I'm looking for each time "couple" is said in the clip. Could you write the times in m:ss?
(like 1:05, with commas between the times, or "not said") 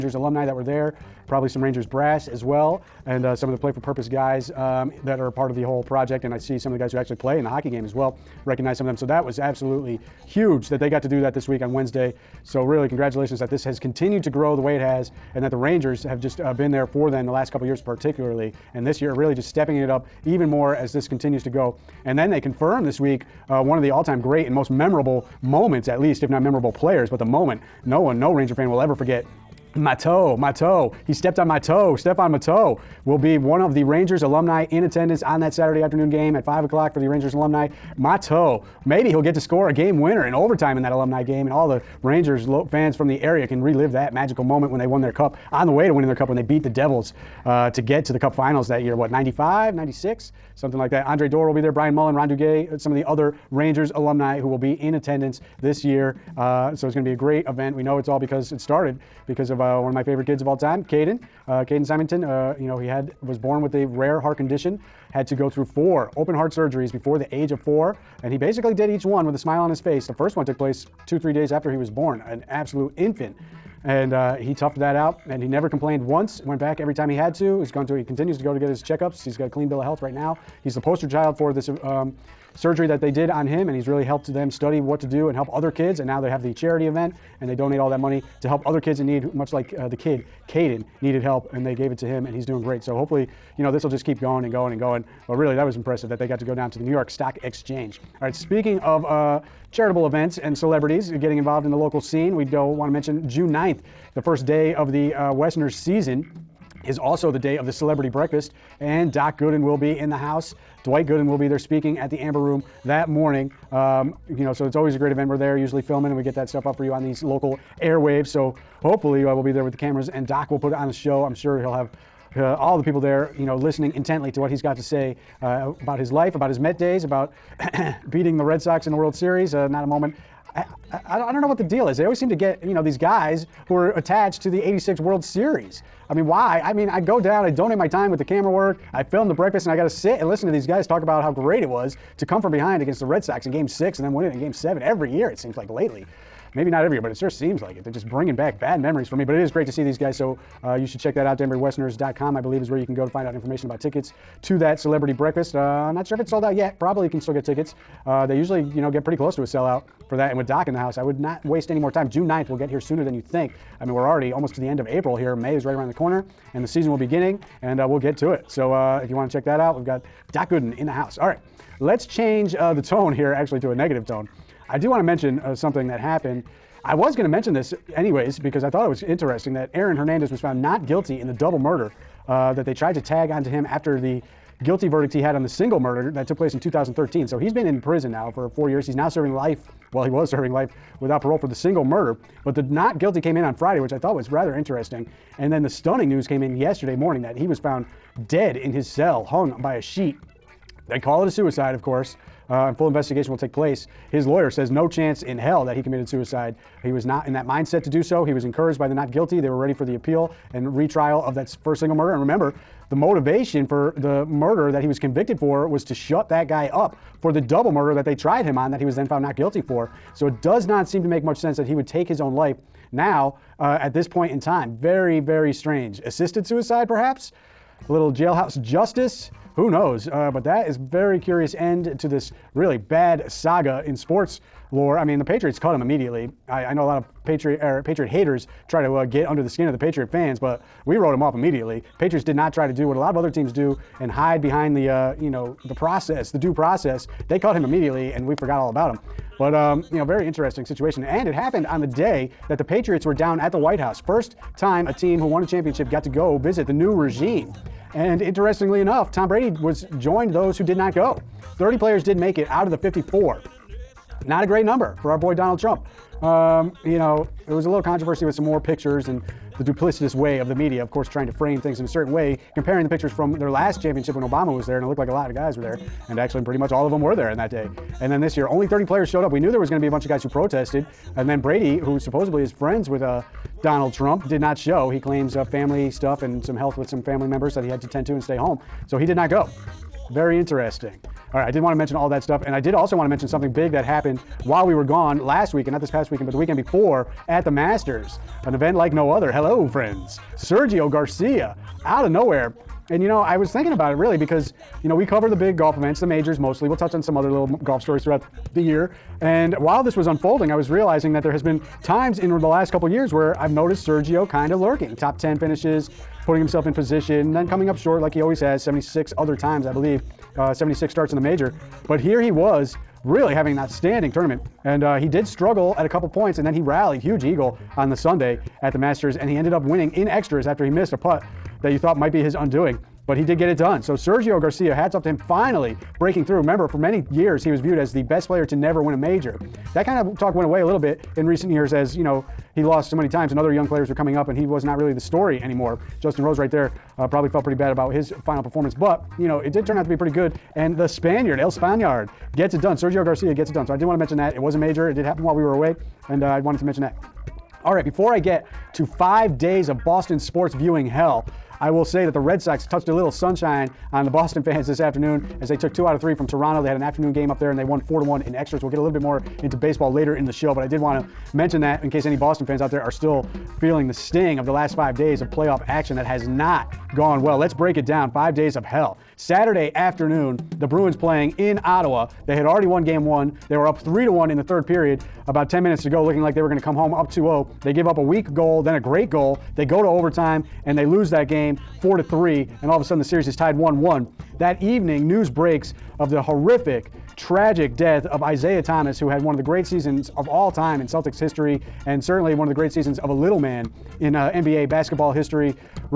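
0:17, 5:12, 5:25.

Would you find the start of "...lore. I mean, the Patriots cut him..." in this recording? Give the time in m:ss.
3:54.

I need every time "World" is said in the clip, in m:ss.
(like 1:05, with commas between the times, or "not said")
2:08, 2:14.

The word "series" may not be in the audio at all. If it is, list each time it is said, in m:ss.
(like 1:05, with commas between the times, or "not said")
2:09, 2:15, 6:33.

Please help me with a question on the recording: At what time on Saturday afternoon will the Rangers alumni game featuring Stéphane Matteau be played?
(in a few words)
5 o'clock.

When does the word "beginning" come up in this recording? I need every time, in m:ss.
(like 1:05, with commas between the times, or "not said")
2:47.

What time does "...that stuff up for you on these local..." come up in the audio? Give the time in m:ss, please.
1:56.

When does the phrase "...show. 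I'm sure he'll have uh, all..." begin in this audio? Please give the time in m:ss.
2:00.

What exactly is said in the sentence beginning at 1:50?
Dwight Gooden will be there speaking at the Amber Room that morning.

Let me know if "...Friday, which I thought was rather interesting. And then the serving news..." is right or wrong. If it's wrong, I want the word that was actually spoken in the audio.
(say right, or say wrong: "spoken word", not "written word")
wrong: "stunning", not "serving".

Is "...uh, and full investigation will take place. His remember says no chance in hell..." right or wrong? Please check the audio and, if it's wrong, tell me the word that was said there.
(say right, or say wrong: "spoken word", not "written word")
wrong: "lawyer", not "remember".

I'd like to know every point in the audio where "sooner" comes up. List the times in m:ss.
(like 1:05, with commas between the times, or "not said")
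2:42.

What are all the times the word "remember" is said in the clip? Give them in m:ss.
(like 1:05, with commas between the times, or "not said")
3:32, 5:36.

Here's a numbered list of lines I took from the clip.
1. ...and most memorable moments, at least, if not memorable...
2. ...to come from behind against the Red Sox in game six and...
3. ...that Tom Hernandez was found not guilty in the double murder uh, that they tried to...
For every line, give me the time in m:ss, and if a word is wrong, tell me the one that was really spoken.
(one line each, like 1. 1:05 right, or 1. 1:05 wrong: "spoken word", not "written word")
1. 0:24 right
2. 2:22 right
3. 2:59 wrong: "Aaron", not "Tom".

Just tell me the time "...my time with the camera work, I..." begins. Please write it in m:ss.
2:17.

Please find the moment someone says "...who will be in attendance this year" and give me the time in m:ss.
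0:54.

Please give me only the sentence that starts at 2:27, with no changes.
They're just bringing back bad memories for me.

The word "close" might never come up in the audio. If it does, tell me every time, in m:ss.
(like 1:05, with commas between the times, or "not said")
2:39.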